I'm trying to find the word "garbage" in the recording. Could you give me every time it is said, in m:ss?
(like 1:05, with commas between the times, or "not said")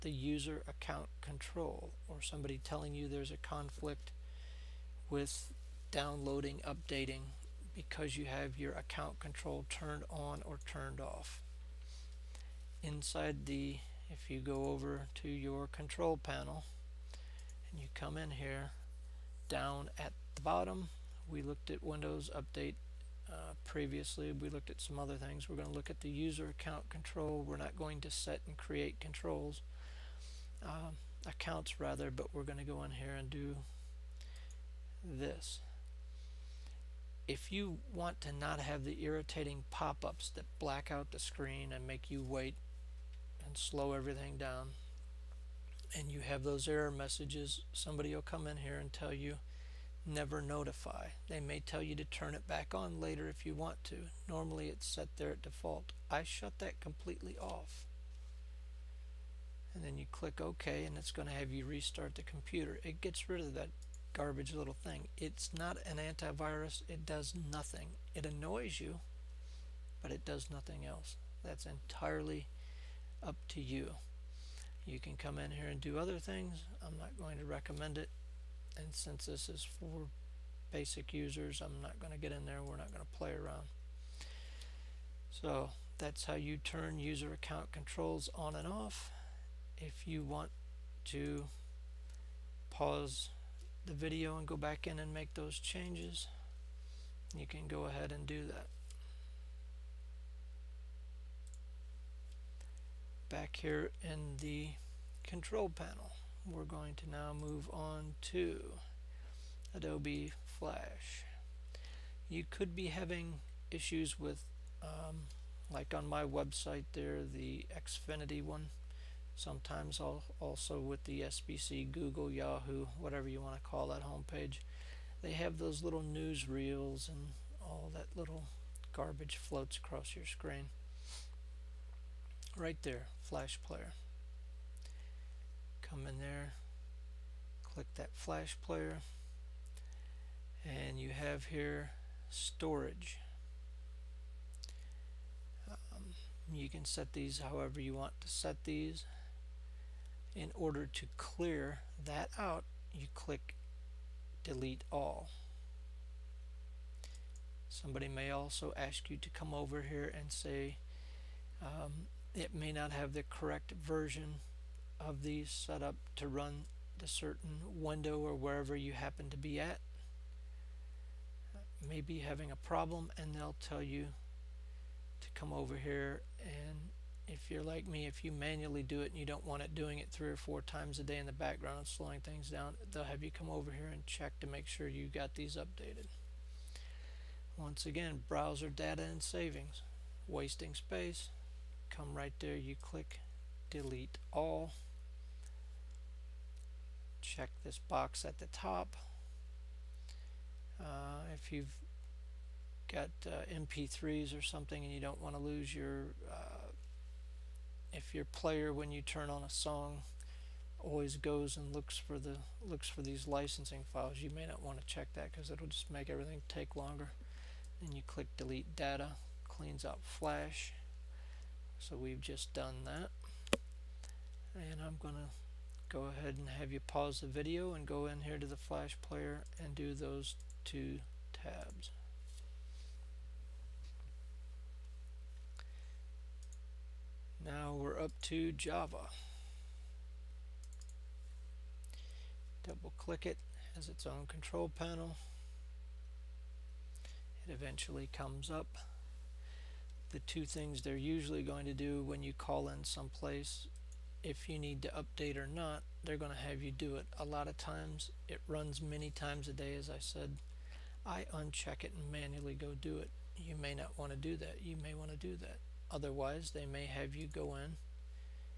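1:04, 2:08.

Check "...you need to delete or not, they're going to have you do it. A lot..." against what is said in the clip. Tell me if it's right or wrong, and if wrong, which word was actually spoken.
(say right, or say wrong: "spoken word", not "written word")
wrong: "update", not "delete".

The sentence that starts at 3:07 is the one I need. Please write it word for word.
Once again, browser data and savings.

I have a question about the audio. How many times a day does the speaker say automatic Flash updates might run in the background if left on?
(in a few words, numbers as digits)
3 or 4.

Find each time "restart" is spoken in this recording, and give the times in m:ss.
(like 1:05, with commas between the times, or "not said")
1:01.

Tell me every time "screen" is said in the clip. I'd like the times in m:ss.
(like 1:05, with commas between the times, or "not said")
0:41, 2:10.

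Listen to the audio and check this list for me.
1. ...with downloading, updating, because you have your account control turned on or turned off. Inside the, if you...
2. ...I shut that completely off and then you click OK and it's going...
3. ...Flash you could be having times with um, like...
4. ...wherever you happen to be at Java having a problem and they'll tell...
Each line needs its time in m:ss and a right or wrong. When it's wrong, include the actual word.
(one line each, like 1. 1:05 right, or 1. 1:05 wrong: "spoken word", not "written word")
1. 0:05 right
2. 0:56 right
3. 1:50 wrong: "issues", not "times"
4. 2:48 wrong: "Maybe", not "Java".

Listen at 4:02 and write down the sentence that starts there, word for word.
Double click it, has its own control panel.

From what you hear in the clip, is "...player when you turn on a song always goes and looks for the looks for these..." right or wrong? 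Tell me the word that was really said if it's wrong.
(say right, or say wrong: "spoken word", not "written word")
right.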